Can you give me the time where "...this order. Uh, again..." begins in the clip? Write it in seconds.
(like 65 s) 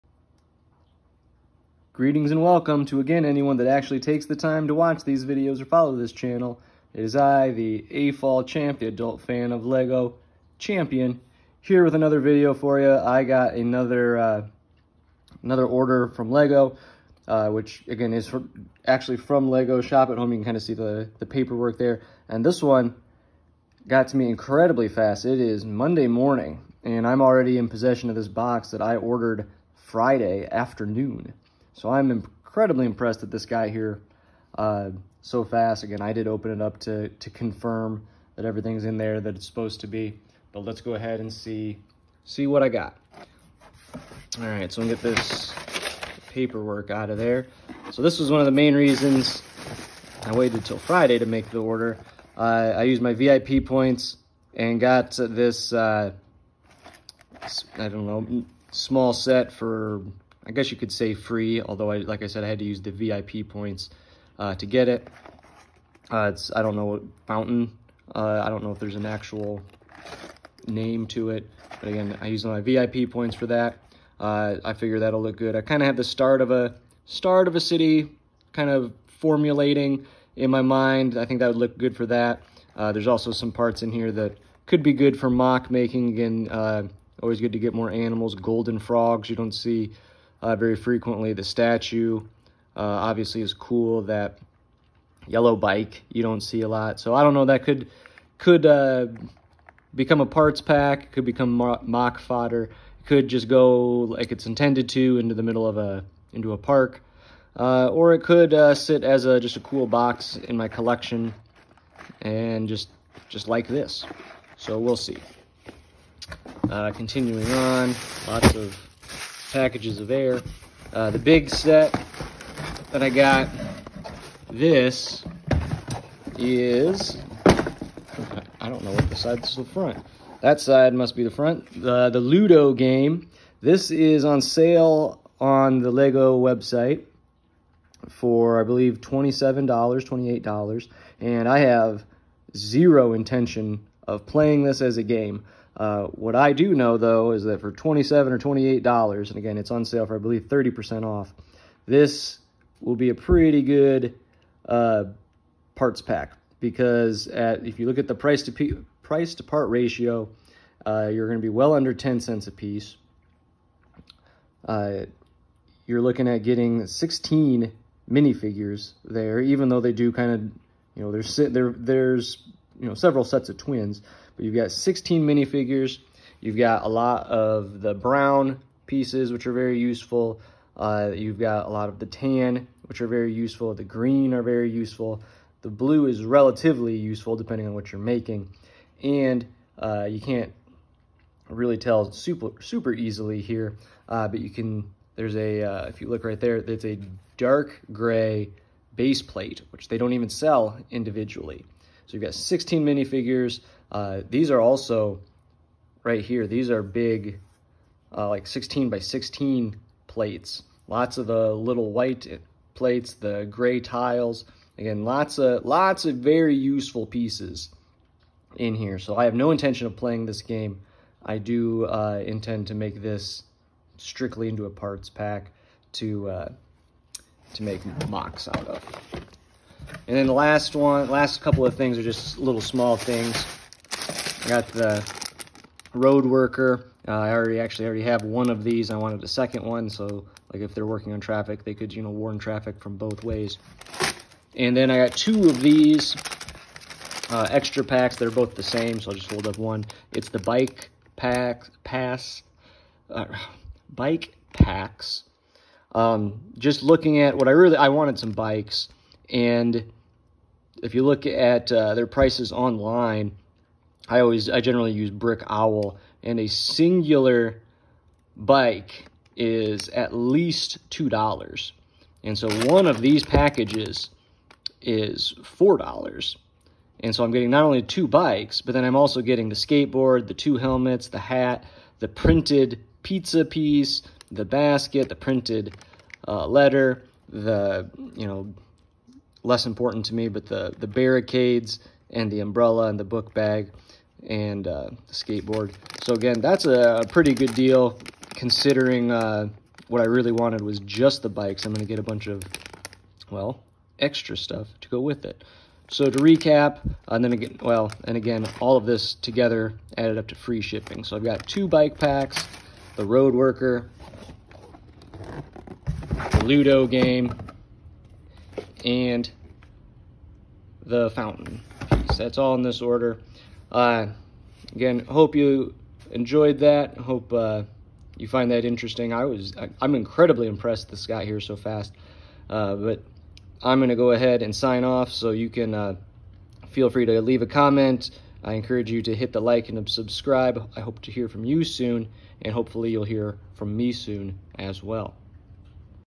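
322 s.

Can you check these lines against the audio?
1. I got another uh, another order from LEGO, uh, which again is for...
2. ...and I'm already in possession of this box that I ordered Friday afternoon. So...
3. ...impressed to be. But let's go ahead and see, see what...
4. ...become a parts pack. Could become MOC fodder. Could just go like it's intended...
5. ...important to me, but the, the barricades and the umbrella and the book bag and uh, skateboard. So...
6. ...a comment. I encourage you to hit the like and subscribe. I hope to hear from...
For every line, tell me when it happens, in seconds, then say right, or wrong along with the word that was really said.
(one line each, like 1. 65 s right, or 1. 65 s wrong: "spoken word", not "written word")
1. 12 s right
2. 26 s right
3. 39 s wrong: "supposed", not "impressed"
4. 99 s right
5. 289 s right
6. 337 s right.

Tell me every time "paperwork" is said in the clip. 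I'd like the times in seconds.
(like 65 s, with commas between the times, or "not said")
21 s, 46 s.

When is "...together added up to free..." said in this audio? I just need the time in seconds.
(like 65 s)
309 s.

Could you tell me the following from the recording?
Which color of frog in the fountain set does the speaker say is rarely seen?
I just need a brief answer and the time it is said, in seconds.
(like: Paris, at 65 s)
Golden, at 88 s.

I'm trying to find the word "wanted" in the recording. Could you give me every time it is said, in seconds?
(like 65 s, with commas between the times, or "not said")
238 s, 257 s, 300 s.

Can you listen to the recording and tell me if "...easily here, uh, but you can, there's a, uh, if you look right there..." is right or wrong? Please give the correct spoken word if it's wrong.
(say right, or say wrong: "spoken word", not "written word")
right.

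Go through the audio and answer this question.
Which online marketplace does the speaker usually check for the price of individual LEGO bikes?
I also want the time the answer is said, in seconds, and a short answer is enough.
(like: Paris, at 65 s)
Brick Owl, at 265 s.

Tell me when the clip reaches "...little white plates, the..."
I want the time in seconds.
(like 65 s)
211 s.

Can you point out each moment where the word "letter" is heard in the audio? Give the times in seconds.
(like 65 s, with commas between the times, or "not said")
286 s.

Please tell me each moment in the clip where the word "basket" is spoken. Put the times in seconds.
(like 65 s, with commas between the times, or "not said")
284 s.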